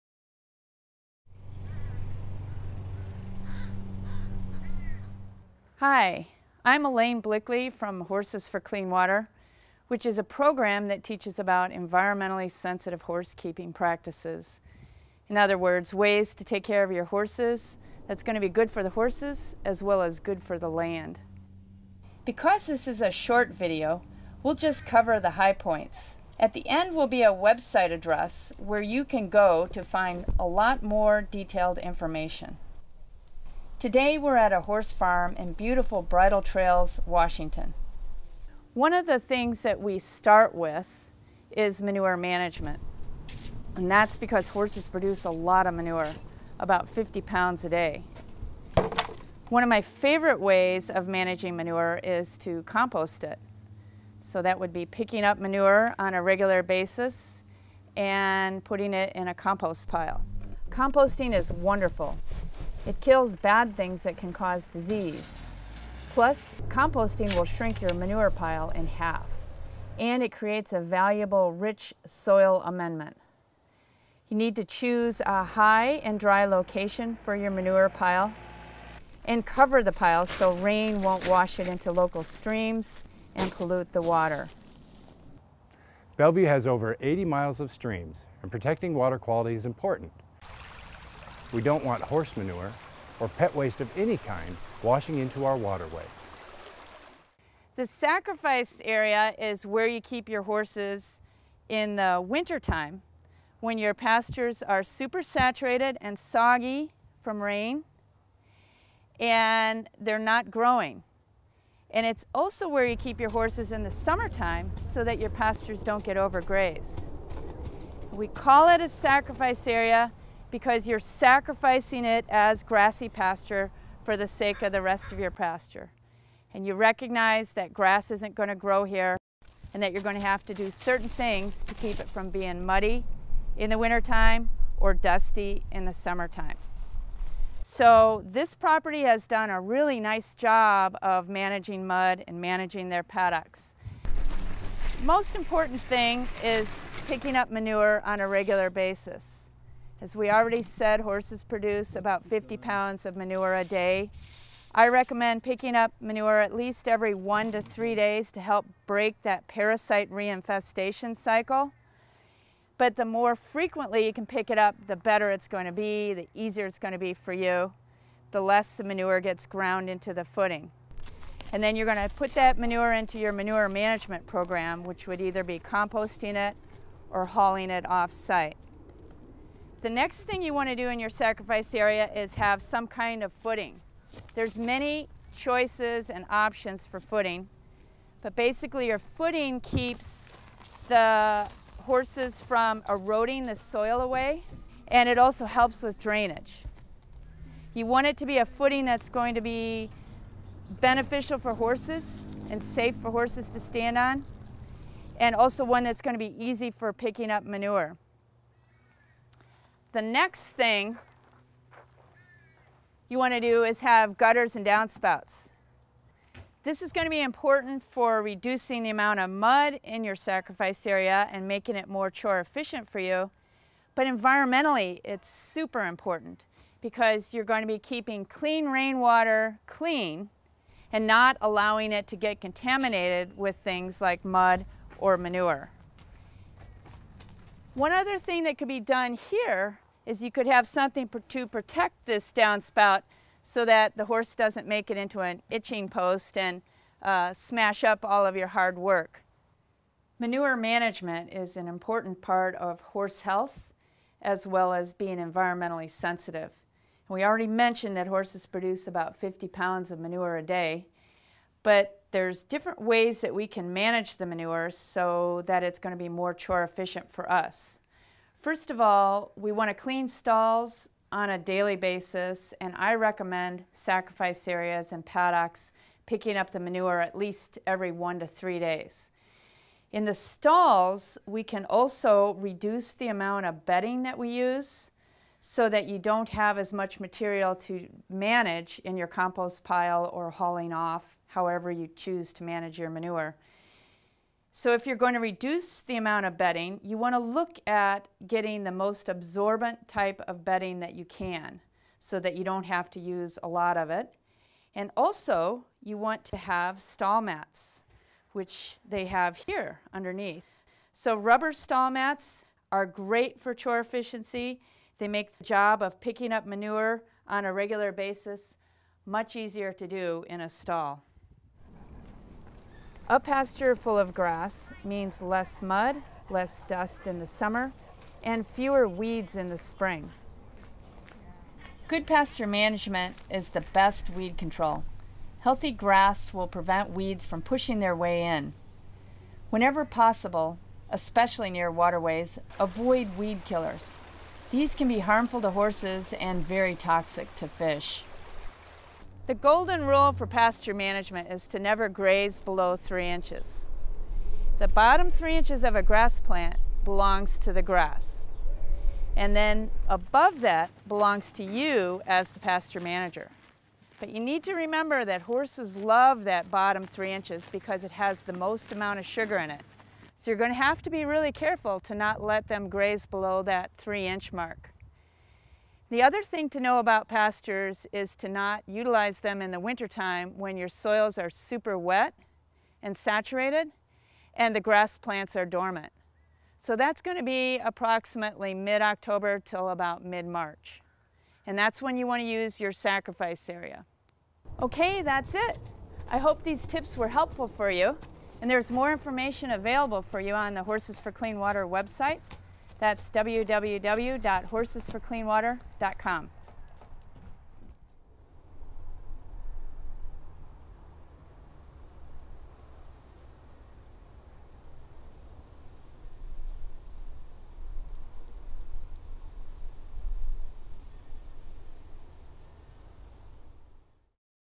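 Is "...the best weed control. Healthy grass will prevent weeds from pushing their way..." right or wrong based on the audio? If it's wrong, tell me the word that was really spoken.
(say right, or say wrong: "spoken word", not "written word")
right.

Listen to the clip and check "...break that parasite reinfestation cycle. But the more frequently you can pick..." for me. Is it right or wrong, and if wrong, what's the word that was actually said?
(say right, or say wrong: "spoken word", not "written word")
right.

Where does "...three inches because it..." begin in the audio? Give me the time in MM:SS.
06:06.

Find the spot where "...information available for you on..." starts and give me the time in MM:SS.
06:38.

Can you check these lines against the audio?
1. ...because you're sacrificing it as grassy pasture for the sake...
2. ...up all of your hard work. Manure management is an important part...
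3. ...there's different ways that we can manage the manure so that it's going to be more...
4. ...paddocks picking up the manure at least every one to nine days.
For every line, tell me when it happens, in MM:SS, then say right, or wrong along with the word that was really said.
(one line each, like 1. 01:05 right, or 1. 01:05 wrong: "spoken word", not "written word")
1. 02:00 right
2. 04:07 right
3. 04:22 right
4. 04:35 wrong: "three", not "nine".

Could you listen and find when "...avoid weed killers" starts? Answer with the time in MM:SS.
05:42.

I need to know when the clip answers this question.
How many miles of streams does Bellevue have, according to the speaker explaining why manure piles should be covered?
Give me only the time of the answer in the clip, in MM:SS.
01:26.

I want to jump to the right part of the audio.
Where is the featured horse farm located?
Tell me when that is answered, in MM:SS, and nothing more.
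00:36.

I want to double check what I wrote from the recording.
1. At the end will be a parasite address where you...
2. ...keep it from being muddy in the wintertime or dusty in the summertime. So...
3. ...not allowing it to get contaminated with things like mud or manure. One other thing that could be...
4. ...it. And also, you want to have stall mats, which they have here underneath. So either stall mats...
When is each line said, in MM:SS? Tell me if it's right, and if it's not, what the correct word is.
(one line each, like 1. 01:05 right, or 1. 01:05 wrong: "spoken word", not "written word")
1. 00:26 wrong: "website", not "parasite"
2. 02:11 right
3. 03:51 right
4. 05:03 wrong: "rubber", not "either".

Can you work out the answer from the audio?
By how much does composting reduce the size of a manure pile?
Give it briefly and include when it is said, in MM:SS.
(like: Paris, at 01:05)
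in half, at 01:07.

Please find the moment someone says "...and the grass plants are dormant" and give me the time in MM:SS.
06:24.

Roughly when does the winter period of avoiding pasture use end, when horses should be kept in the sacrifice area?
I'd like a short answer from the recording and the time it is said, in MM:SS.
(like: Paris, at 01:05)
mid-March, at 06:30.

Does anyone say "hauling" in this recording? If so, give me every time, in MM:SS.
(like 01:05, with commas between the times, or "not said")
02:57, 04:50.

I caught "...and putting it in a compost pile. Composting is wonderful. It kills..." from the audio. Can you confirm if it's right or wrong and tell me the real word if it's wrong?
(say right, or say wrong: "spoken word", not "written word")
right.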